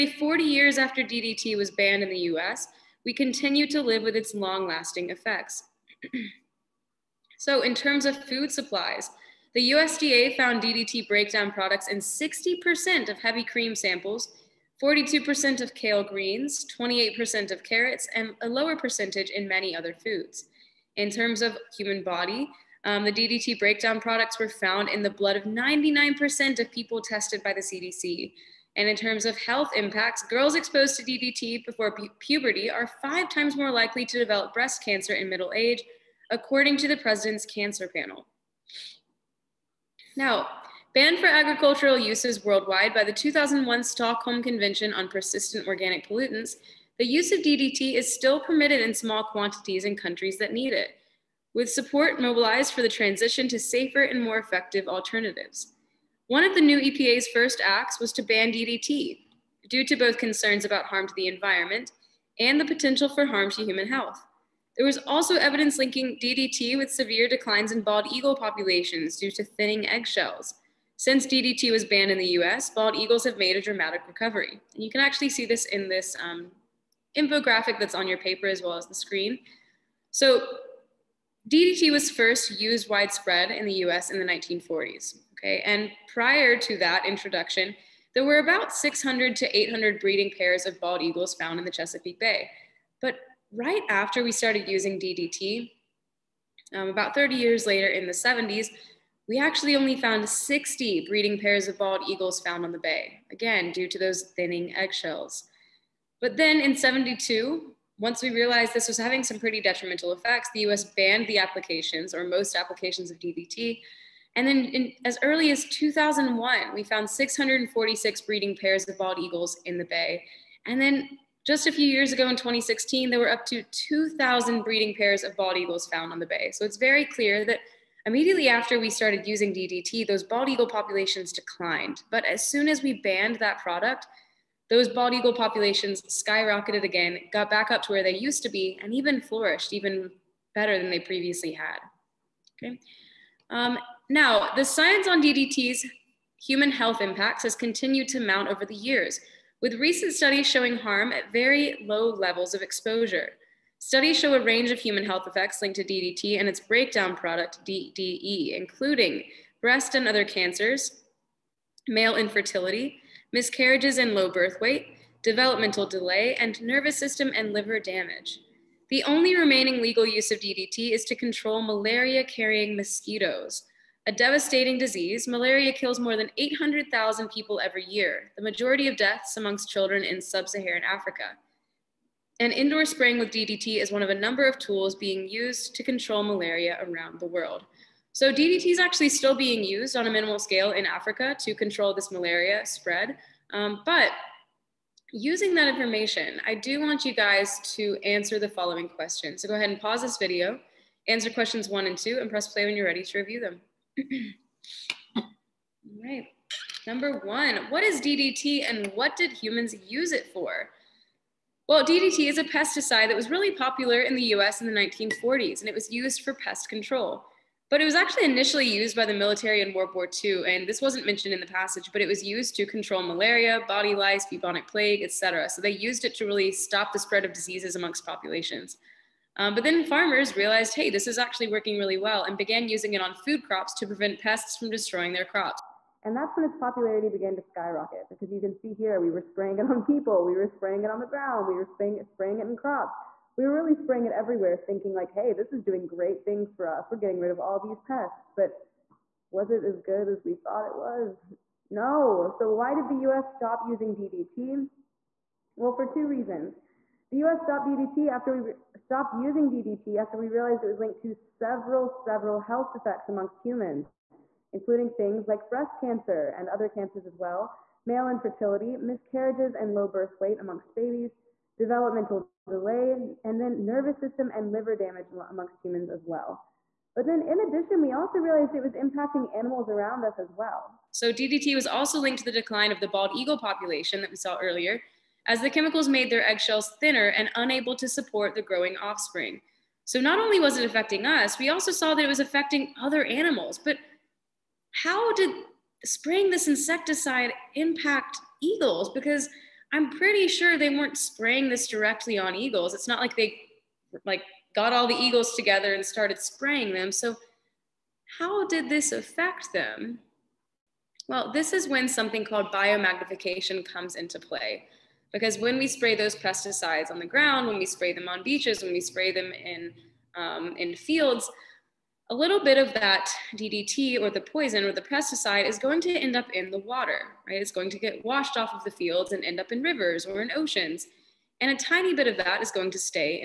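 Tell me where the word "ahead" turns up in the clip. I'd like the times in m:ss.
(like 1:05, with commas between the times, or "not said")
3:19.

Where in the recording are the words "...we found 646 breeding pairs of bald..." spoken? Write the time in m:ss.
1:56.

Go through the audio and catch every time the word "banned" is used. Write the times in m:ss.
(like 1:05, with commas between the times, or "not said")
0:01, 0:40, 1:11, 1:50, 2:13.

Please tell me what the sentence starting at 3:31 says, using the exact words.
Well, DDT is a pesticide that was really popular in the US in the 1940s, and it was used for pest control.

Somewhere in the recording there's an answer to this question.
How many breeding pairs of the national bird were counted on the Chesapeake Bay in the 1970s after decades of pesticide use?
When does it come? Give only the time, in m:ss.
1:40.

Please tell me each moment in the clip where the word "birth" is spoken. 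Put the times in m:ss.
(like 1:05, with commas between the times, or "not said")
2:44, 4:29.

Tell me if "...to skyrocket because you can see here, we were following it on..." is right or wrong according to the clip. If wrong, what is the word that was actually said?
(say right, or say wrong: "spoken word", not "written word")
wrong: "spraying", not "following".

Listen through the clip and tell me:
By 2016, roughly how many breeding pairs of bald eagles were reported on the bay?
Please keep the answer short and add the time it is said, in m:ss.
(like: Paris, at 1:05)
2,000, at 2:03.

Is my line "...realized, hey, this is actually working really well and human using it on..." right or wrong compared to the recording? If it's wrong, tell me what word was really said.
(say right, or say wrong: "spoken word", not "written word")
wrong: "began", not "human".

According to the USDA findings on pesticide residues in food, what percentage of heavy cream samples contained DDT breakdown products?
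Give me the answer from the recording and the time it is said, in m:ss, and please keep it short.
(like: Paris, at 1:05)
60%, at 0:11.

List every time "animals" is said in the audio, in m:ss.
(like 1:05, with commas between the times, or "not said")
4:39, 4:53.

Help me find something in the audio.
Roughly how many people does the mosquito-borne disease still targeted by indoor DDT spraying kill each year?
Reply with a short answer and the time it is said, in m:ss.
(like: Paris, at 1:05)
800,000, at 2:56.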